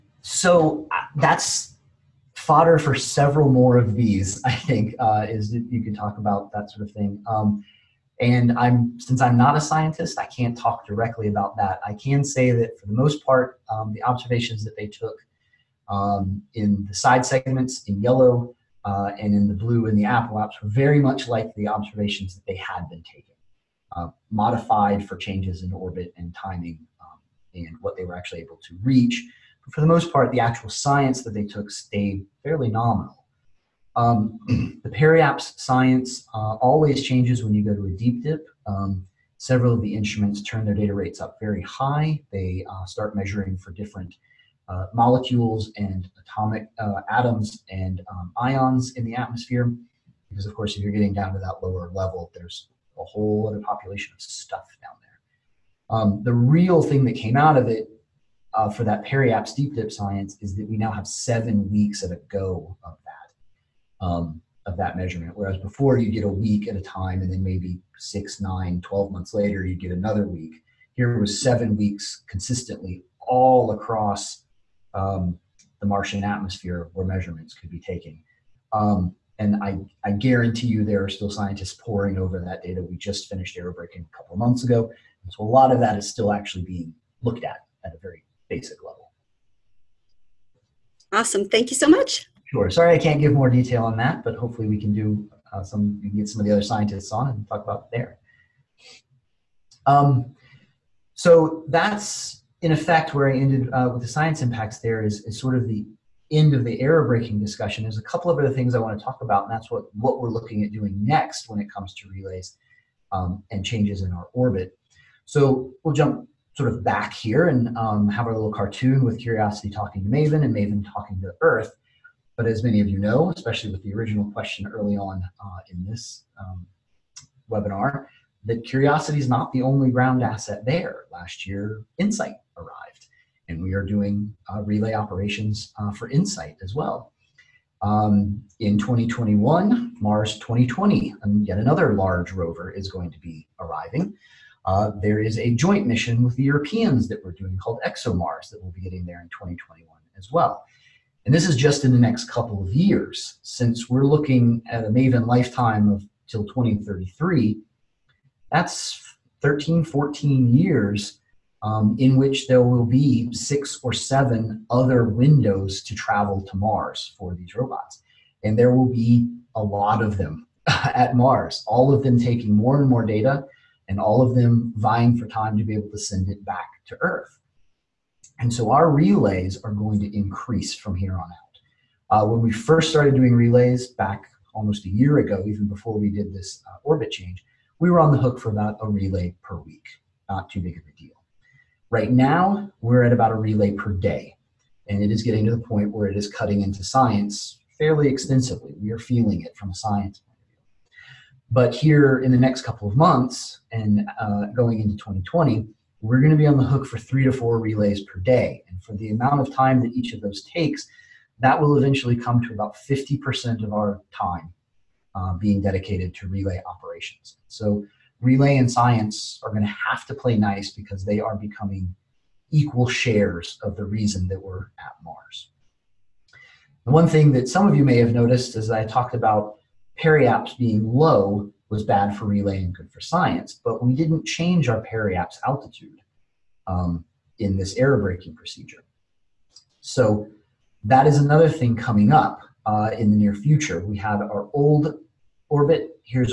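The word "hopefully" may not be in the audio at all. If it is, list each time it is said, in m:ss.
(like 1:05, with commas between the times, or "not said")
1:34.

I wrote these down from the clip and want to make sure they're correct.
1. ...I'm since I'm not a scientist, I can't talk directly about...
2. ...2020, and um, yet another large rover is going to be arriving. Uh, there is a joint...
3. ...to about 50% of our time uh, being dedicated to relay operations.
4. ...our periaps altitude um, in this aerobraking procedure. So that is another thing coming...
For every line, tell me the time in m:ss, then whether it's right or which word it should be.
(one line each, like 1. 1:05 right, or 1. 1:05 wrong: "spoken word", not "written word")
1. 0:08 right
2. 2:20 right
3. 3:32 right
4. 3:54 right.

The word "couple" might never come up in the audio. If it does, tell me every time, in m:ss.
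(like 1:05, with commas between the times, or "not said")
1:24, 1:48, 2:32, 3:22.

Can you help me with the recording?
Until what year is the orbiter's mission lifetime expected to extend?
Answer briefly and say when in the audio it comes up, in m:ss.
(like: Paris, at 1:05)
2033, at 2:36.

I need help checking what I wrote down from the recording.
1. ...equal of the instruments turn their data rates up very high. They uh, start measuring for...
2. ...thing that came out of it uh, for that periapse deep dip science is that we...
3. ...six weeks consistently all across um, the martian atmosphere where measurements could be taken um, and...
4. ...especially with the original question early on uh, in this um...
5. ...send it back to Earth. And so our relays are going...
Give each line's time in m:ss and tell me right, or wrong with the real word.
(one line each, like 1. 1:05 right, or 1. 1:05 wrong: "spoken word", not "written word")
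1. 0:39 wrong: "several", not "equal"
2. 0:56 right
3. 1:11 wrong: "seven", not "six"
4. 2:03 right
5. 2:55 right.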